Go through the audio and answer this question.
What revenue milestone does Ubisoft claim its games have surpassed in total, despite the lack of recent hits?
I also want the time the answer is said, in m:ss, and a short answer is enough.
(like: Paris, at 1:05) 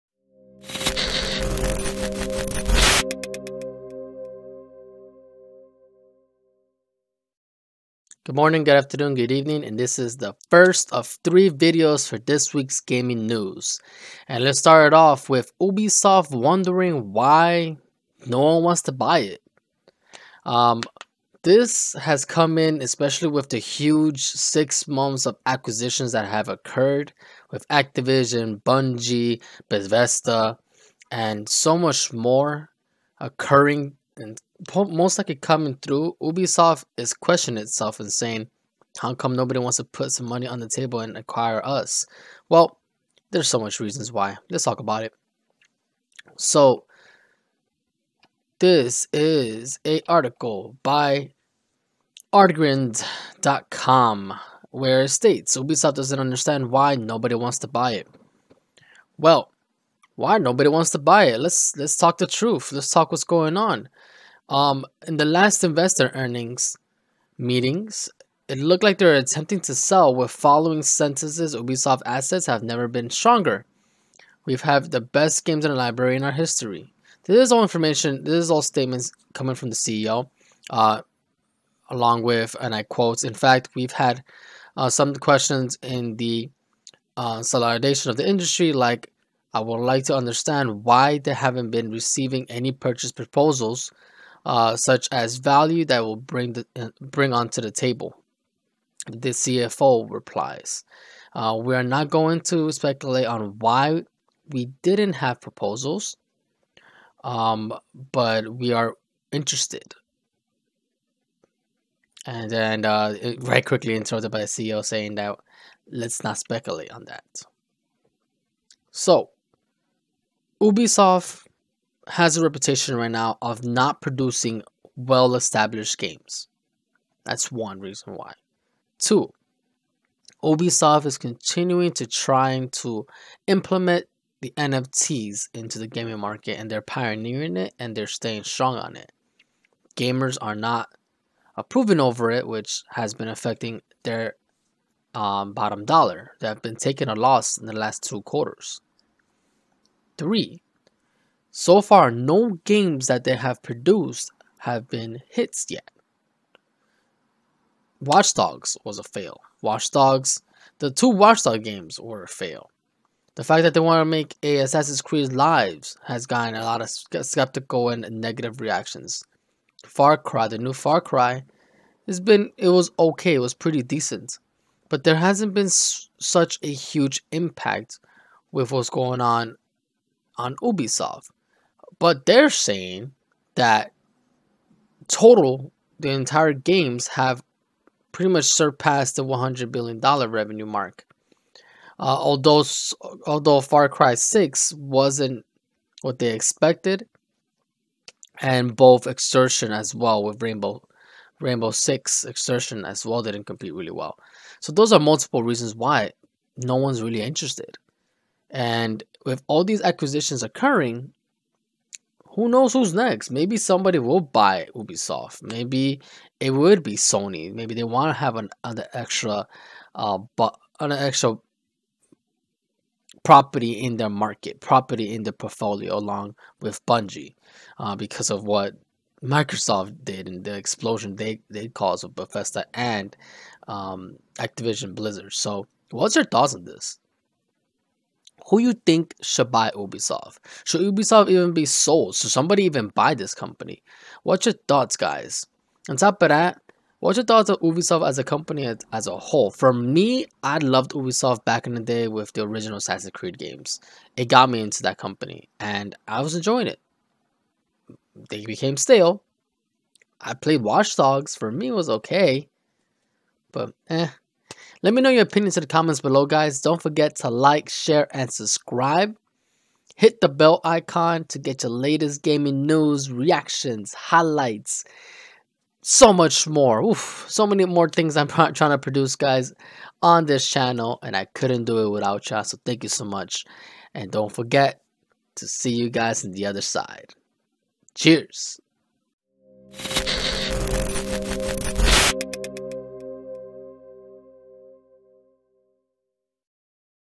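$100 billion, at 3:09.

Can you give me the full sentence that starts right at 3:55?
So, what's your thoughts on this?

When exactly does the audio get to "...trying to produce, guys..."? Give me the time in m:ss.
4:38.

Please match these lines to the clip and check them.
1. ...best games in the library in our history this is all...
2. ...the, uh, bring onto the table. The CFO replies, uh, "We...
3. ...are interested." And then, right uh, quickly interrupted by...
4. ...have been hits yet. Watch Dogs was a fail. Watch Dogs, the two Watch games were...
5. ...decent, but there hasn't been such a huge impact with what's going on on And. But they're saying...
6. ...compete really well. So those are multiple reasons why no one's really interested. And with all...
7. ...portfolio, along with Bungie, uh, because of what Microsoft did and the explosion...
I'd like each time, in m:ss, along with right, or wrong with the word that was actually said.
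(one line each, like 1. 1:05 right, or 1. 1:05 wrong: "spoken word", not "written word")
1. 1:15 right
2. 1:36 right
3. 1:48 right
4. 2:34 right
5. 2:53 wrong: "Ubisoft", not "And"
6. 3:23 right
7. 3:45 right.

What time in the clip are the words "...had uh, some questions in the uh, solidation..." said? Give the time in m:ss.
1:23.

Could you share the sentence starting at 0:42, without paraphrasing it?
Well, there's so much reasons why.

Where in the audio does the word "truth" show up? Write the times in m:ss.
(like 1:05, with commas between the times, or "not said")
1:02.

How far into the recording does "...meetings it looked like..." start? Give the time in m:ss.
1:07.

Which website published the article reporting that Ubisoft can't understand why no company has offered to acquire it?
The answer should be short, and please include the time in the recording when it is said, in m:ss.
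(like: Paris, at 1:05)
artgrind.com, at 0:52.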